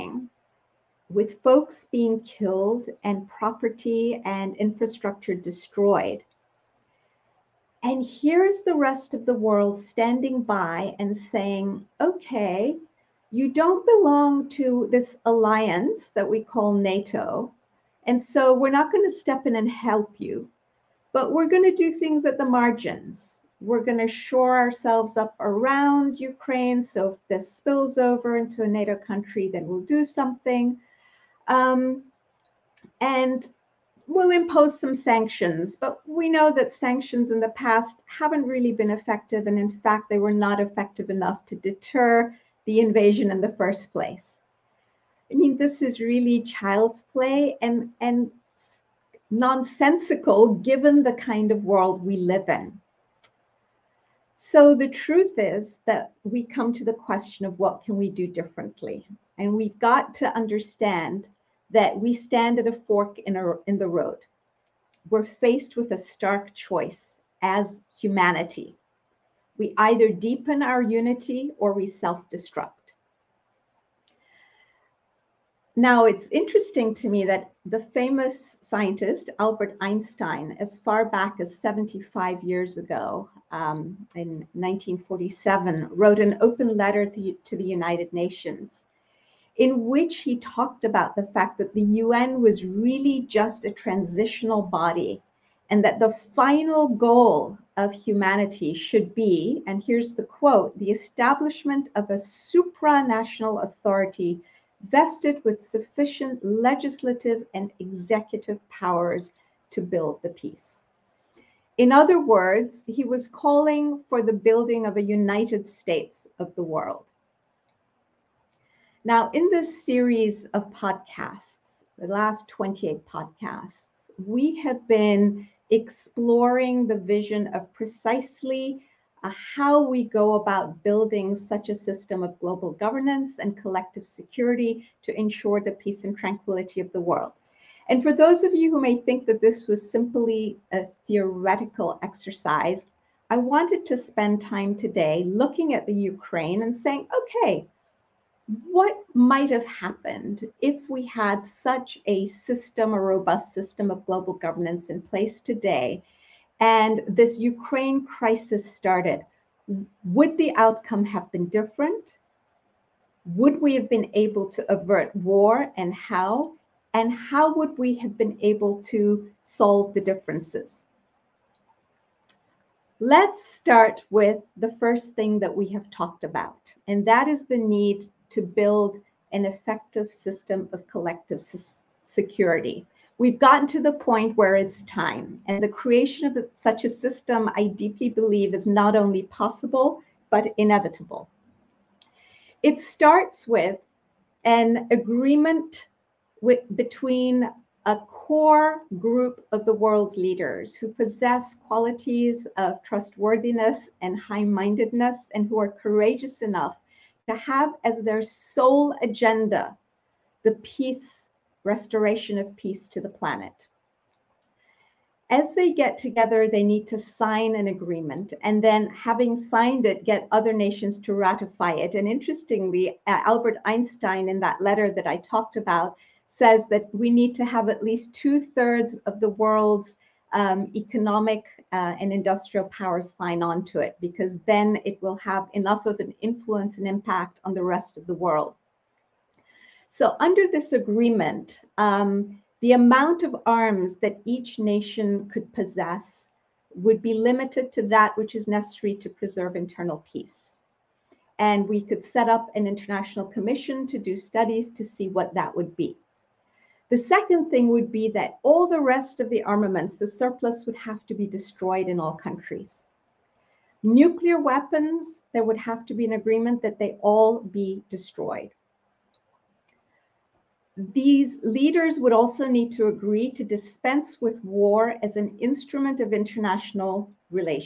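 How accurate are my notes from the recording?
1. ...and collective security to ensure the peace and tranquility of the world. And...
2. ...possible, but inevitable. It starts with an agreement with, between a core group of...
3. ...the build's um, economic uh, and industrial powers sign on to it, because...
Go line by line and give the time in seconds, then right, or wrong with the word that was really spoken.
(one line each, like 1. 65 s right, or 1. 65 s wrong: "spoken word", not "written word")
1. 133 s right
2. 189 s right
3. 229 s wrong: "world", not "build".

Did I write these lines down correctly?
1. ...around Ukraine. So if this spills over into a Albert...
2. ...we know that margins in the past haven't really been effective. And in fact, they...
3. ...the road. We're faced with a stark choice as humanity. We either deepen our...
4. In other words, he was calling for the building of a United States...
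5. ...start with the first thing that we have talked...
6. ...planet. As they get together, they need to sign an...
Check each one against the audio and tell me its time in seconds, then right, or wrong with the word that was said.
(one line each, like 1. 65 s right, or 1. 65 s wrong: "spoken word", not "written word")
1. 25 s wrong: "NATO", not "Albert"
2. 36 s wrong: "sanctions", not "margins"
3. 63 s right
4. 111 s right
5. 173 s right
6. 213 s right.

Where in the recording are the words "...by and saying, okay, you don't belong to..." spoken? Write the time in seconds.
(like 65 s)
10 s.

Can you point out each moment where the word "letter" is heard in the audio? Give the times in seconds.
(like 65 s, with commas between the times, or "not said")
86 s, 224 s.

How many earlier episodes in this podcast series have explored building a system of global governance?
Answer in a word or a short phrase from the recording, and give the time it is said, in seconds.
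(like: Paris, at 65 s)
28, at 122 s.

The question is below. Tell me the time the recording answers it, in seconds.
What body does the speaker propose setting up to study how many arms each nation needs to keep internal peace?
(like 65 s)
252 s.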